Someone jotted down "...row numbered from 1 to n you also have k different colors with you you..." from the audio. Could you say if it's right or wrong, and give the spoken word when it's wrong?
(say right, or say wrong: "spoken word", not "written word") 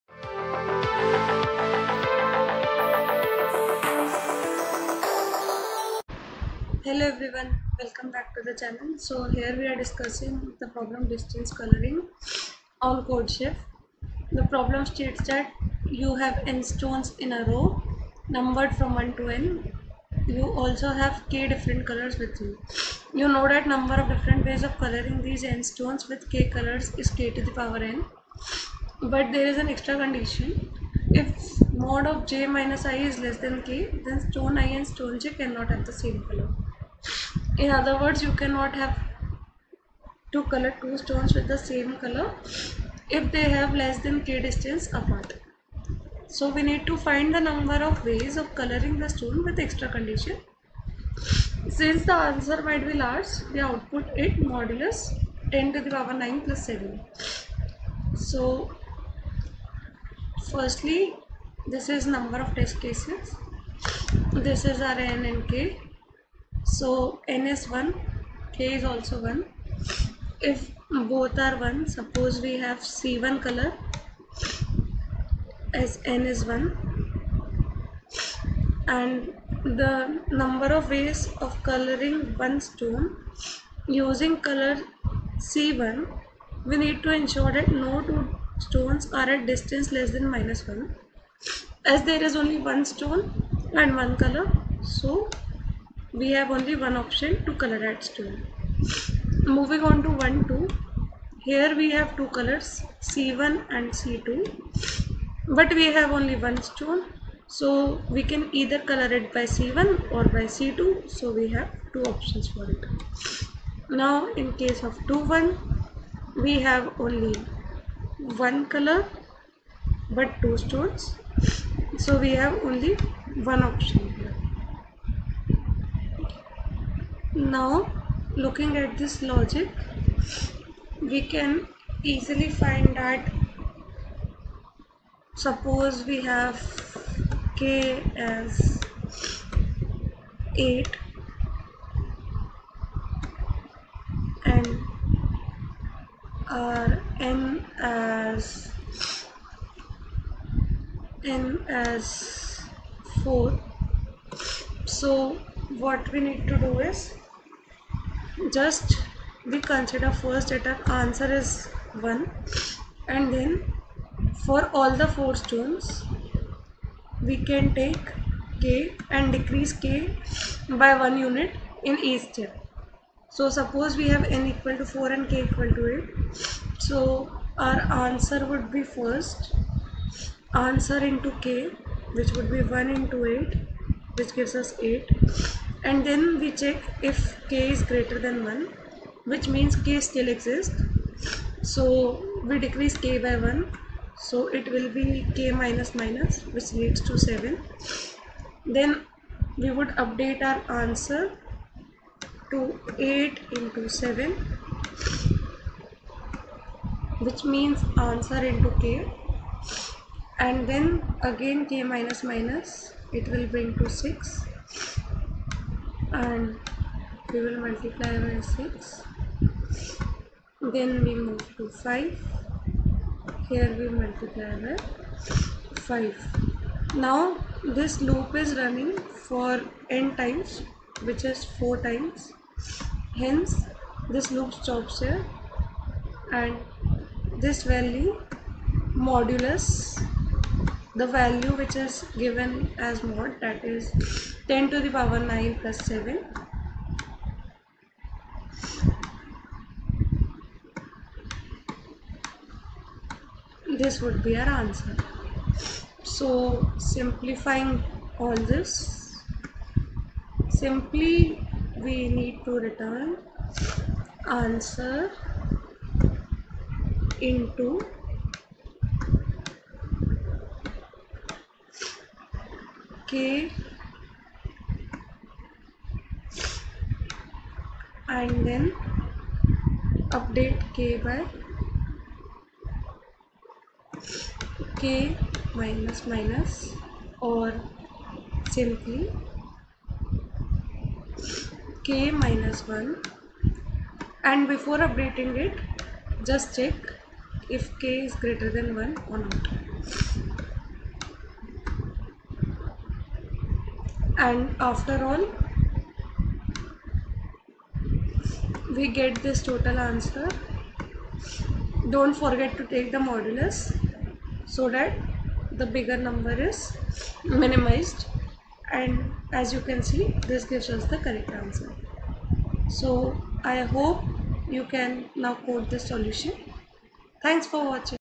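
right.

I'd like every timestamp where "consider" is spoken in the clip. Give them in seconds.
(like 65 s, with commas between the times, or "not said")
159 s.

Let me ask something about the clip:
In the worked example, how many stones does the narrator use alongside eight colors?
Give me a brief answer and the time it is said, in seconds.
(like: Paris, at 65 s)
4, at 151 s.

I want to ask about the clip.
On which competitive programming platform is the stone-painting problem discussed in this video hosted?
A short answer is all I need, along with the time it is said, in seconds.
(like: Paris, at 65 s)
CodeChef, at 13 s.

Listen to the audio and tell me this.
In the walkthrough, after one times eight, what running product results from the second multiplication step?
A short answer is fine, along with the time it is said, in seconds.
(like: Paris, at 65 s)
8 into 7, at 202 s.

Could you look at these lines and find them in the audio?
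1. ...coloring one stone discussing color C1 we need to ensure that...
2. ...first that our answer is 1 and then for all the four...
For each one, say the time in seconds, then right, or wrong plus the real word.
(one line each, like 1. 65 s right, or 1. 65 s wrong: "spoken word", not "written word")
1. 81 s wrong: "using", not "discussing"
2. 160 s right.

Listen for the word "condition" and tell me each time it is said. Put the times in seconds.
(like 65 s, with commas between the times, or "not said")
30 s, 49 s.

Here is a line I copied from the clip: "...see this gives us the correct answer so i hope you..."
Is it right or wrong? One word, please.
right.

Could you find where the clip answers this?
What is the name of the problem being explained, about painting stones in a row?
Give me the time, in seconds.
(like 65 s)
11 s.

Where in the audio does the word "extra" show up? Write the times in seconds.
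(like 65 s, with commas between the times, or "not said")
29 s, 49 s.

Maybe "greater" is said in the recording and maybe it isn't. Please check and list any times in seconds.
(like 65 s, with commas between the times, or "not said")
187 s.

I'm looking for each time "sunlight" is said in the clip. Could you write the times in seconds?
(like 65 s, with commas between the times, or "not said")
not said.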